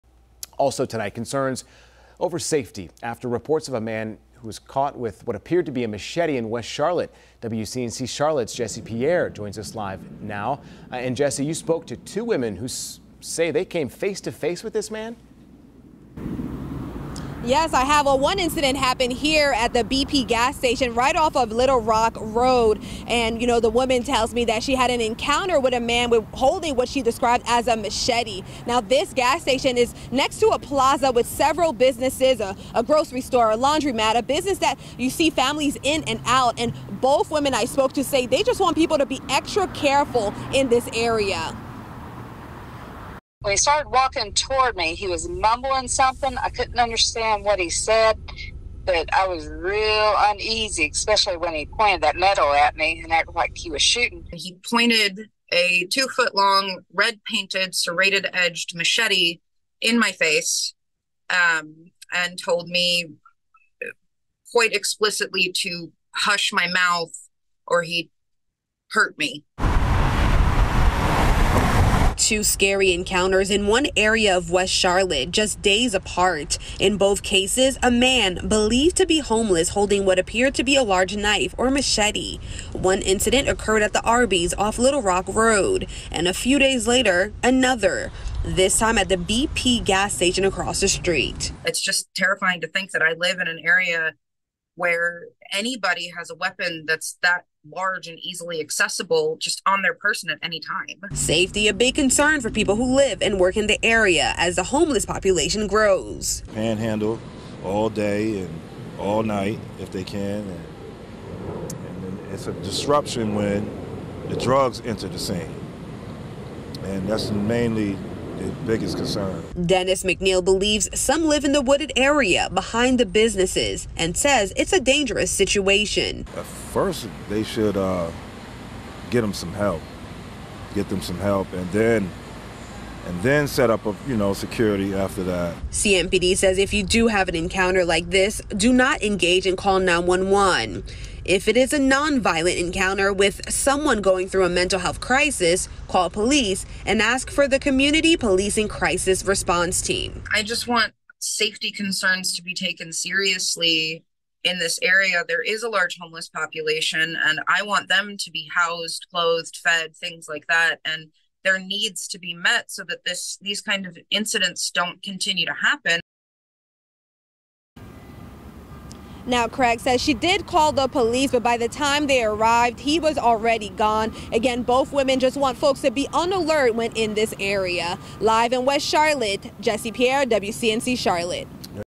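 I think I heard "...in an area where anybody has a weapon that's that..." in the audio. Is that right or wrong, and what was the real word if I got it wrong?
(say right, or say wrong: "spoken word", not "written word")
right.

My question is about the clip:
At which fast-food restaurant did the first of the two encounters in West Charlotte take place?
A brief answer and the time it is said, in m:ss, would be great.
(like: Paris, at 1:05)
Arby's, at 1:24.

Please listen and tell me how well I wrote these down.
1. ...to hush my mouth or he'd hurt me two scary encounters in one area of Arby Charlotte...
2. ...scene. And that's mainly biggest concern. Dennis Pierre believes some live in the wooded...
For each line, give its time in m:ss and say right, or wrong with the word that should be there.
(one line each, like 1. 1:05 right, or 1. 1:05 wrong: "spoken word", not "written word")
1. 1:05 wrong: "West", not "Arby"
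2. 1:55 wrong: "McNeil", not "Pierre".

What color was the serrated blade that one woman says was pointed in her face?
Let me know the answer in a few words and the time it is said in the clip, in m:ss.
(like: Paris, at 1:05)
Red, at 0:56.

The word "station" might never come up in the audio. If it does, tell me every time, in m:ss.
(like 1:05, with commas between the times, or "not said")
0:20, 0:29, 1:30.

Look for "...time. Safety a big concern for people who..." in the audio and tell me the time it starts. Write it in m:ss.
1:40.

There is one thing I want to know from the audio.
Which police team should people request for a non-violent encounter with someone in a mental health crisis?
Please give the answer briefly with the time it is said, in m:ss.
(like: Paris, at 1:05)
Community Policing Crisis Response Team, at 2:27.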